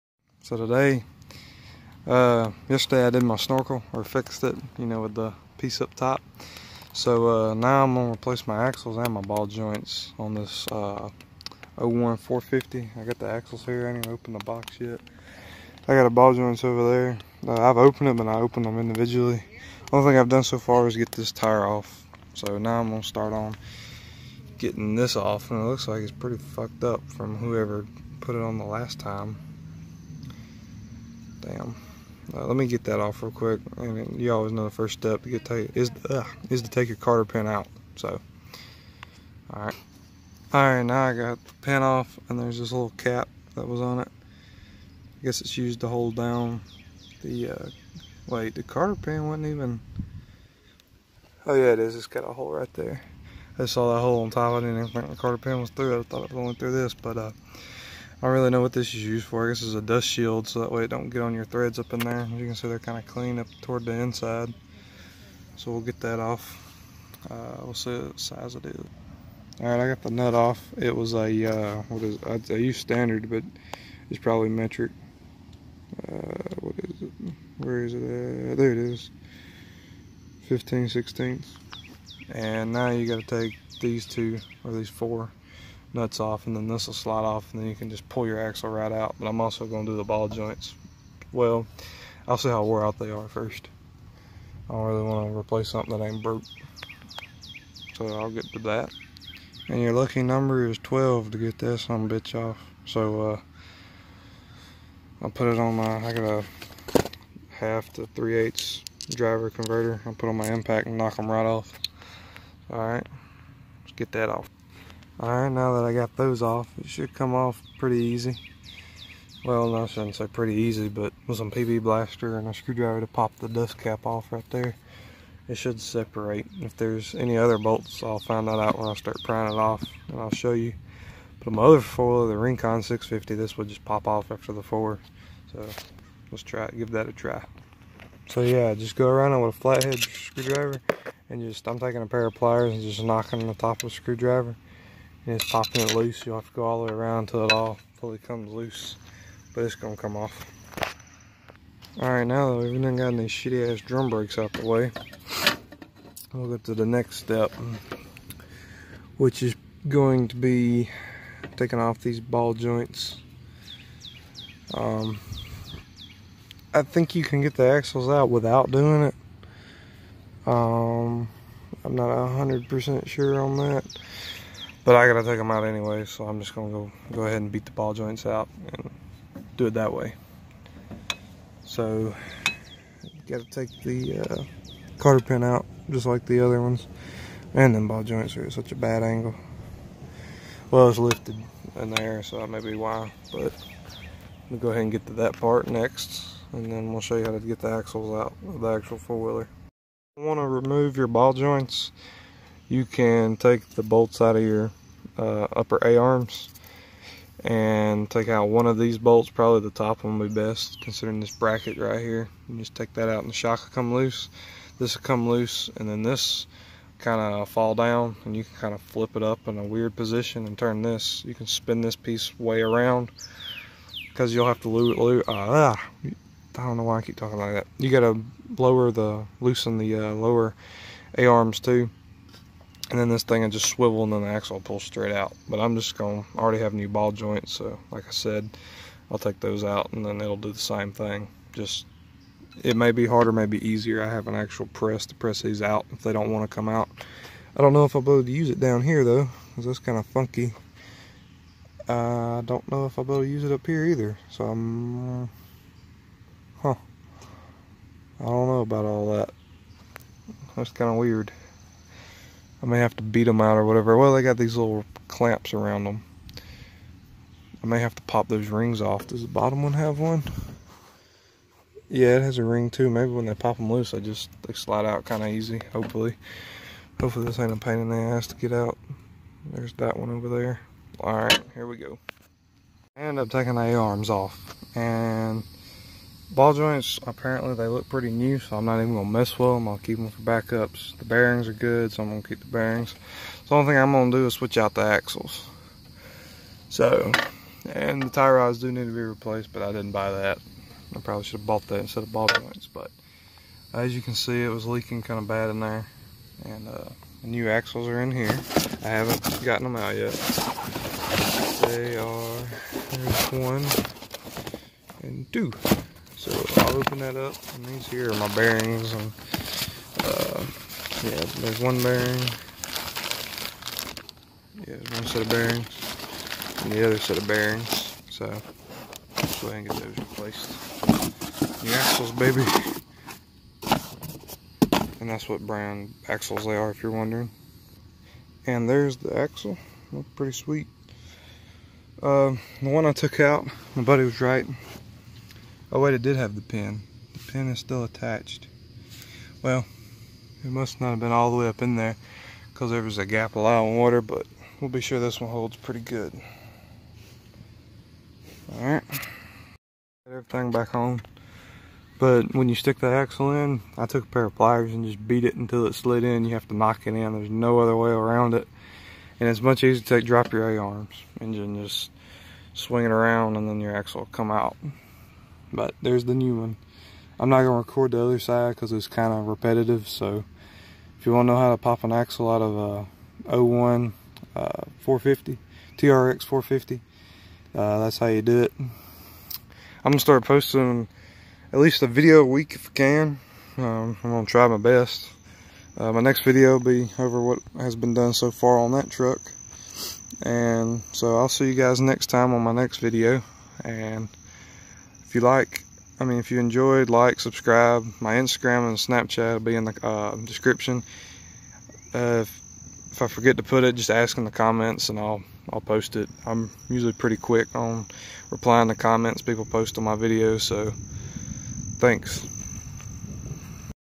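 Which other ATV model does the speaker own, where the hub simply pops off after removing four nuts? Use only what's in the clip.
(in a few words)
Rincon 650.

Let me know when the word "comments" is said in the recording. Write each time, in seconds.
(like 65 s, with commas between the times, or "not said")
414 s, 418 s.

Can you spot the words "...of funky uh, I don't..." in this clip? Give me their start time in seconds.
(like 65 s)
249 s.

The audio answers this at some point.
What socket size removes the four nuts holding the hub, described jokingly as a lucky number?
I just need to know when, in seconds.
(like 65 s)
100 s.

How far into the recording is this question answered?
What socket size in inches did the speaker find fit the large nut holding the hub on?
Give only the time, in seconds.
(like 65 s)
80 s.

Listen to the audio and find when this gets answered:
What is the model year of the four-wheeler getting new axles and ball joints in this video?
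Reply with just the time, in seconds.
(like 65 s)
11 s.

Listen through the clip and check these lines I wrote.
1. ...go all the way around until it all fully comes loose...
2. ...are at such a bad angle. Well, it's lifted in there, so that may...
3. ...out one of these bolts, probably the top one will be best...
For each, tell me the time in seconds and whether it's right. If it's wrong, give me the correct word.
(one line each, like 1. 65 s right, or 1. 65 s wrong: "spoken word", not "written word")
1. 146 s right
2. 188 s right
3. 208 s right.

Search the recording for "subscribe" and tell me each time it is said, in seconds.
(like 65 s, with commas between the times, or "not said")
407 s.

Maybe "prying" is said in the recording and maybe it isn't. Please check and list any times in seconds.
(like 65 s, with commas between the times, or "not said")
129 s.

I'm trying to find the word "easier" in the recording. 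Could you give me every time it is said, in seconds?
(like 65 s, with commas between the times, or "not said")
243 s, 369 s.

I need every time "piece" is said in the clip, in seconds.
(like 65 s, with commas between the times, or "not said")
5 s, 221 s.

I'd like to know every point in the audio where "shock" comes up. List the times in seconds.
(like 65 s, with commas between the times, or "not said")
213 s.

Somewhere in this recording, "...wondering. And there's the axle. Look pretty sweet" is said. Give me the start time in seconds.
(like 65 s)
336 s.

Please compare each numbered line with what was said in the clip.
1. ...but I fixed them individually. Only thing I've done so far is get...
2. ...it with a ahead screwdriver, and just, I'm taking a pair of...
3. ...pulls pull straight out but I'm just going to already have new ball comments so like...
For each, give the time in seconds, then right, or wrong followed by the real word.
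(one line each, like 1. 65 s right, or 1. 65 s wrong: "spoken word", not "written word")
1. 18 s wrong: "opened", not "fixed"
2. 139 s wrong: "flathead", not "ahead"
3. 234 s wrong: "joints", not "comments".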